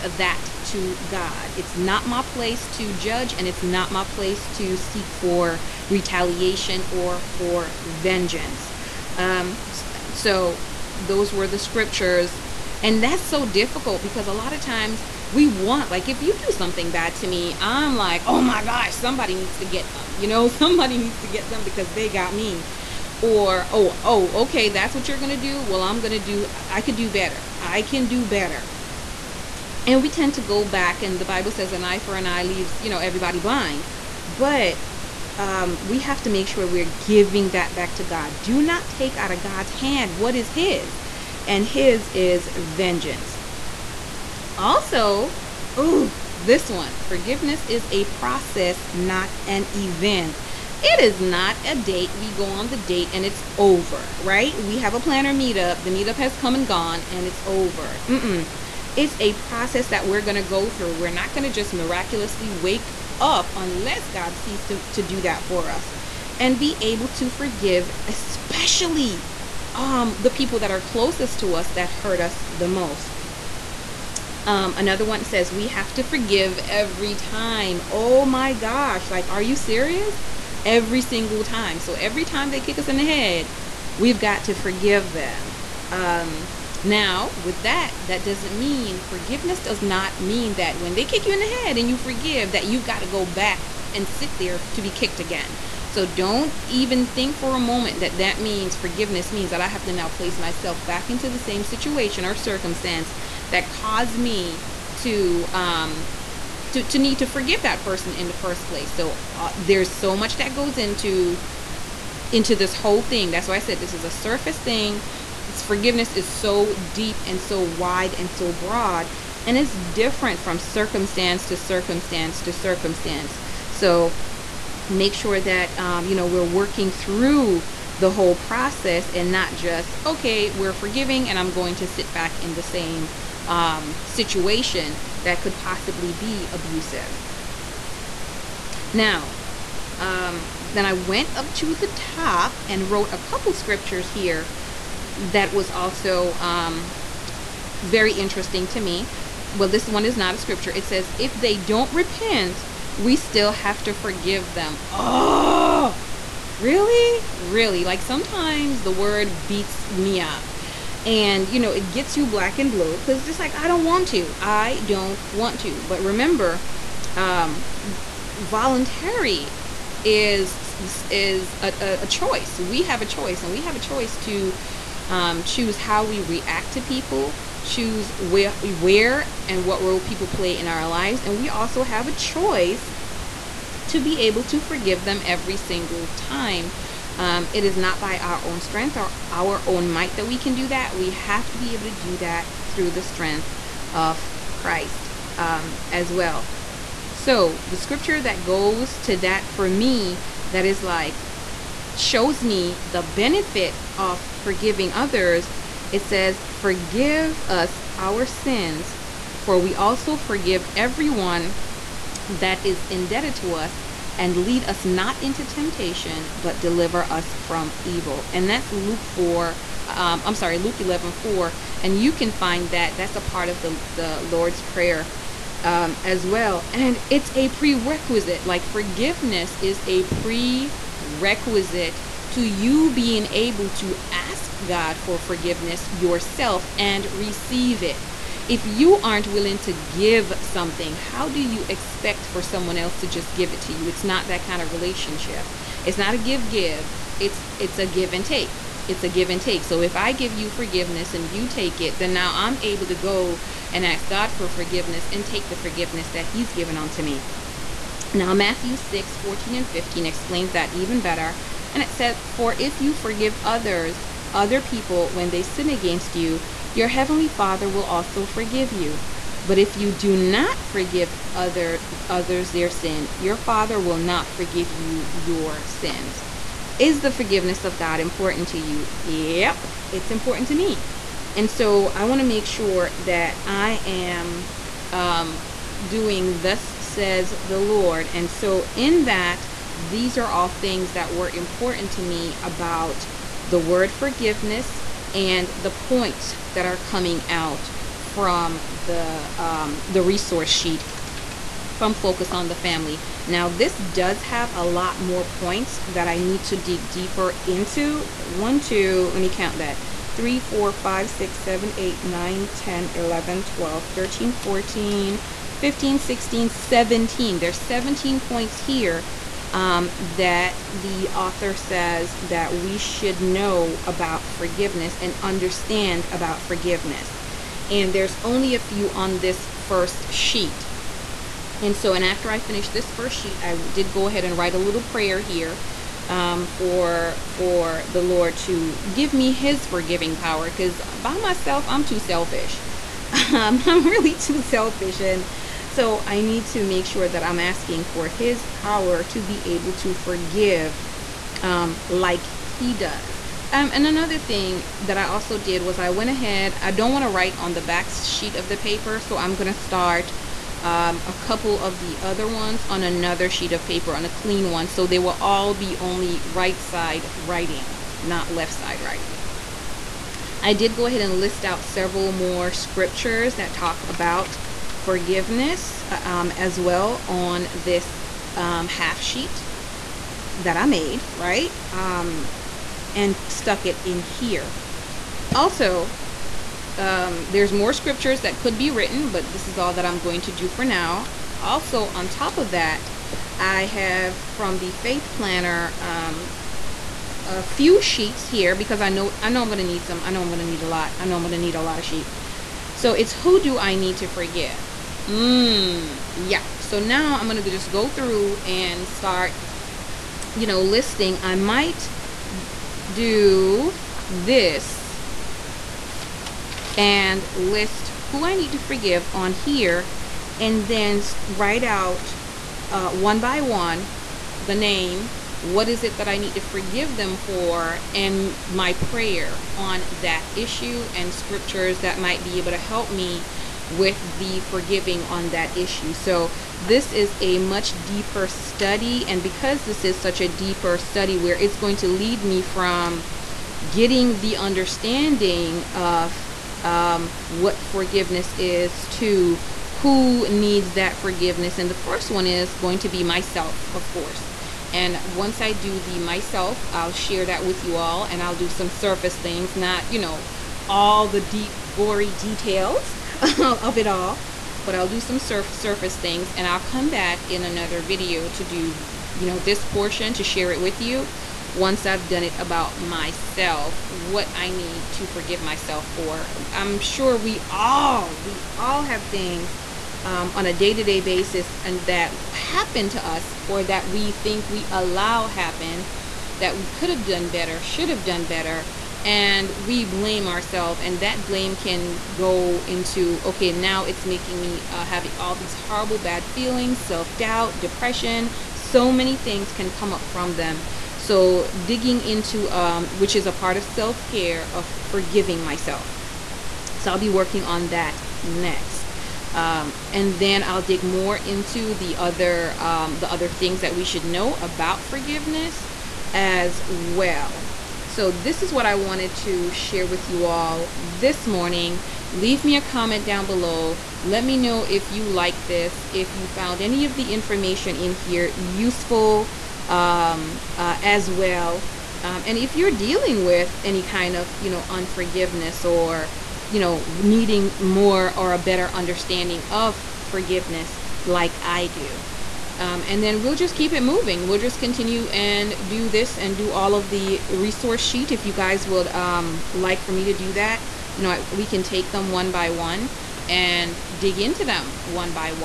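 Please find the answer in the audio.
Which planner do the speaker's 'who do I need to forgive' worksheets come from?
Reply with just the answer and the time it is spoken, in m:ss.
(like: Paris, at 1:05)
Faith Planner, at 6:34.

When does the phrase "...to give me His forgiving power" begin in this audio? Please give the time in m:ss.
5:38.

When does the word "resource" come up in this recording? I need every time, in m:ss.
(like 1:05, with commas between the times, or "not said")
5:00, 9:07.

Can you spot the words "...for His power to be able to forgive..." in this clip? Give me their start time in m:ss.
5:47.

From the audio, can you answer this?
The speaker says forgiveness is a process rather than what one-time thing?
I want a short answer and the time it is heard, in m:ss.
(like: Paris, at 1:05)
an event, at 0:49.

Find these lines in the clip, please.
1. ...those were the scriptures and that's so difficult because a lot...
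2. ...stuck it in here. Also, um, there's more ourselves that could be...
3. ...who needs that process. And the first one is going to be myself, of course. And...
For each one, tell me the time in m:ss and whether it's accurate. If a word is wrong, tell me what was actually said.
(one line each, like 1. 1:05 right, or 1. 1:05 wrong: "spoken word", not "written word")
1. 0:10 right
2. 6:23 wrong: "scriptures", not "ourselves"
3. 7:29 wrong: "forgiveness", not "process".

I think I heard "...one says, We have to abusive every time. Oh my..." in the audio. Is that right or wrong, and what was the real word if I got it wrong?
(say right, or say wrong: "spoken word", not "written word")
wrong: "forgive", not "abusive".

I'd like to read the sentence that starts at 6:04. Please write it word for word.
So they will all be only right side writing, not left side writing.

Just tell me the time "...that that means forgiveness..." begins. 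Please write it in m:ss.
1:37.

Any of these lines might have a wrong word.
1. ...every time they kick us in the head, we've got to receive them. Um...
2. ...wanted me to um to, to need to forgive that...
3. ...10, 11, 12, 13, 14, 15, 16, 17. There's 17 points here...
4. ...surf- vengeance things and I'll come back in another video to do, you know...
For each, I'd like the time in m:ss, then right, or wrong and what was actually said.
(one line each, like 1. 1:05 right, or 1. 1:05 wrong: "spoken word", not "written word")
1. 1:21 wrong: "forgive", not "receive"
2. 1:43 wrong: "caused", not "wanted"
3. 5:12 right
4. 7:45 wrong: "surface", not "vengeance".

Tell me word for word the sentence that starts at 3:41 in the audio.
And you can find that, that's a part of the, the Lord's Prayer um, as well.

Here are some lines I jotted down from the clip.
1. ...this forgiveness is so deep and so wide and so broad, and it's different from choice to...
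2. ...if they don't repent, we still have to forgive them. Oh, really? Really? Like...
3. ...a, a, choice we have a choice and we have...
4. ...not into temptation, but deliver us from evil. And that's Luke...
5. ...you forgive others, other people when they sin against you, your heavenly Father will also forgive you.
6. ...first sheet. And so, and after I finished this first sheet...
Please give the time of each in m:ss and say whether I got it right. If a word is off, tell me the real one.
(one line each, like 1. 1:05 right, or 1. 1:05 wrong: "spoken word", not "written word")
1. 1:55 wrong: "circumstance", not "choice"
2. 2:31 right
3. 2:51 right
4. 3:34 right
5. 4:22 right
6. 5:29 right.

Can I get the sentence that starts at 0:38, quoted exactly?
Do not take out of God's hand what is His, and His is vengeance.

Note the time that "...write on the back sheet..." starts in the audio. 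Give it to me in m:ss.
5:57.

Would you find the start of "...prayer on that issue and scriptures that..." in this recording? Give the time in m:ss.
7:08.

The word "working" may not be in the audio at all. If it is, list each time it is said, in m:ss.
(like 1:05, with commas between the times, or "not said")
2:06, 8:27.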